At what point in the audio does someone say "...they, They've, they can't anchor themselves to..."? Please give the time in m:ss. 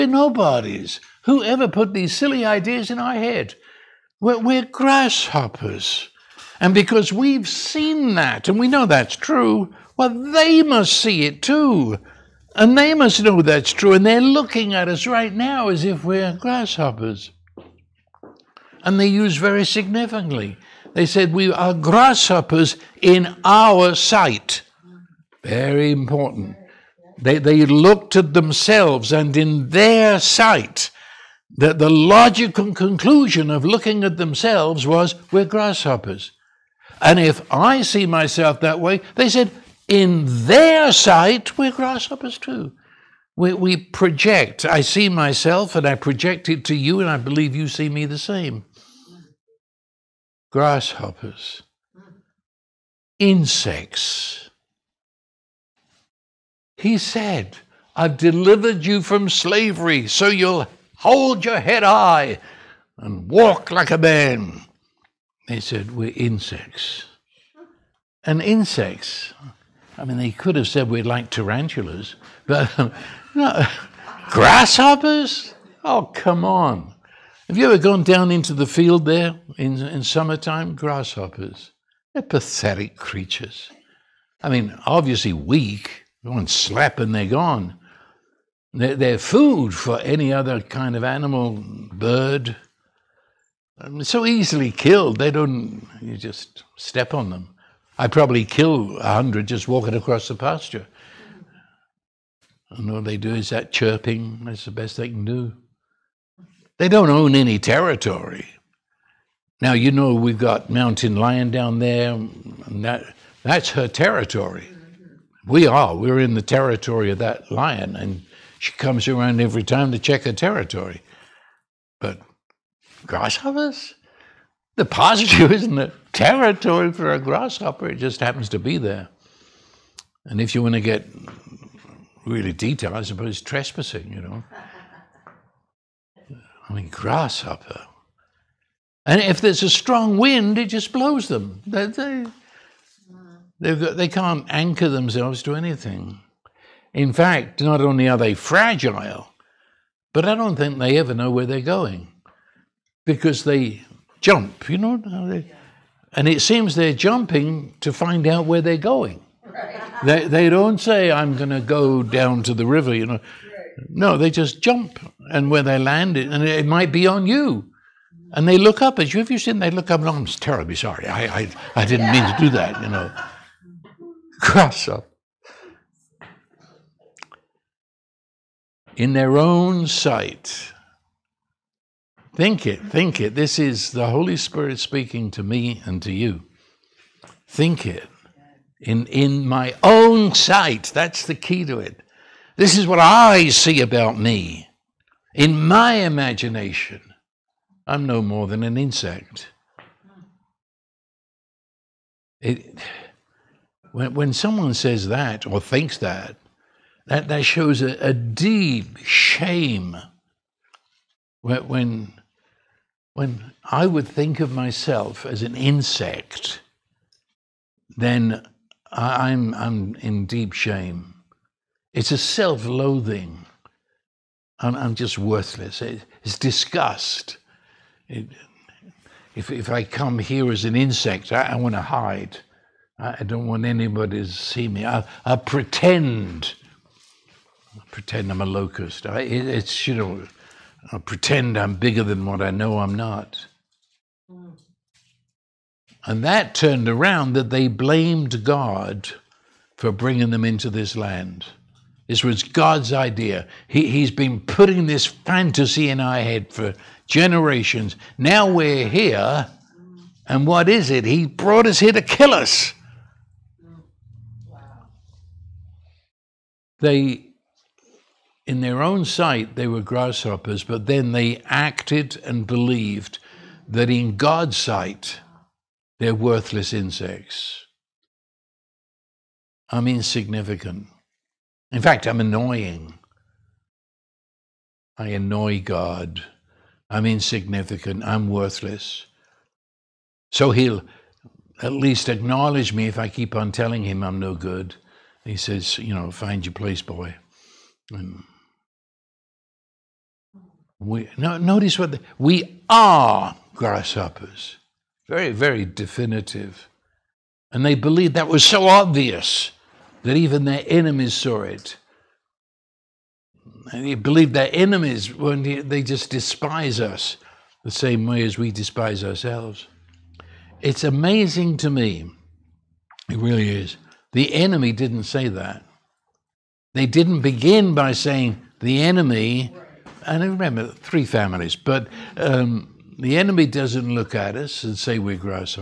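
2:21.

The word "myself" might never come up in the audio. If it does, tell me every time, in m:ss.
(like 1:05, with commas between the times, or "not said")
0:38, 0:45, 3:34.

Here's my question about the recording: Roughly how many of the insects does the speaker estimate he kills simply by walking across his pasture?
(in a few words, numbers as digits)
100.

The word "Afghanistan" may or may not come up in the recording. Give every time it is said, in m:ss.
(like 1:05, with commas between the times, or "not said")
not said.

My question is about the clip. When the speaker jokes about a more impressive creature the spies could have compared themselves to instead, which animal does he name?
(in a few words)
tarantulas.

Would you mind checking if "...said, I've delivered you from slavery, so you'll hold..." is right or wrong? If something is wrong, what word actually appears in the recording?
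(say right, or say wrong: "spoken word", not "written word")
right.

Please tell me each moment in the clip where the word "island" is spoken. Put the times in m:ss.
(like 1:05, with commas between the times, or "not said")
not said.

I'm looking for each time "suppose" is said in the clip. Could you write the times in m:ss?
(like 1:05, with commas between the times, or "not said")
2:13.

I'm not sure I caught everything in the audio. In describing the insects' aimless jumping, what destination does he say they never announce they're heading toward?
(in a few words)
the river.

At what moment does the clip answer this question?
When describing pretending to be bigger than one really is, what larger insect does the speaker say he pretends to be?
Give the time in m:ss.
3:58.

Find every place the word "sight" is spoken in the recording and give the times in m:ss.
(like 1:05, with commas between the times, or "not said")
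0:23, 0:30, 0:40, 2:59, 3:10, 4:29, 4:34.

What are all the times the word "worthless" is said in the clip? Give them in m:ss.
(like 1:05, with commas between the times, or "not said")
3:45, 4:36, 4:48.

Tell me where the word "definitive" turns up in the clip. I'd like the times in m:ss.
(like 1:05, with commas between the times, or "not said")
5:05.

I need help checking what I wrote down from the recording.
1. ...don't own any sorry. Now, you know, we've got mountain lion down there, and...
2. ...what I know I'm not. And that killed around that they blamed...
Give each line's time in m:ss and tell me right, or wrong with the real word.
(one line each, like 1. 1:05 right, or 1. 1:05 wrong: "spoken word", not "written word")
1. 1:46 wrong: "territory", not "sorry"
2. 4:02 wrong: "turned", not "killed".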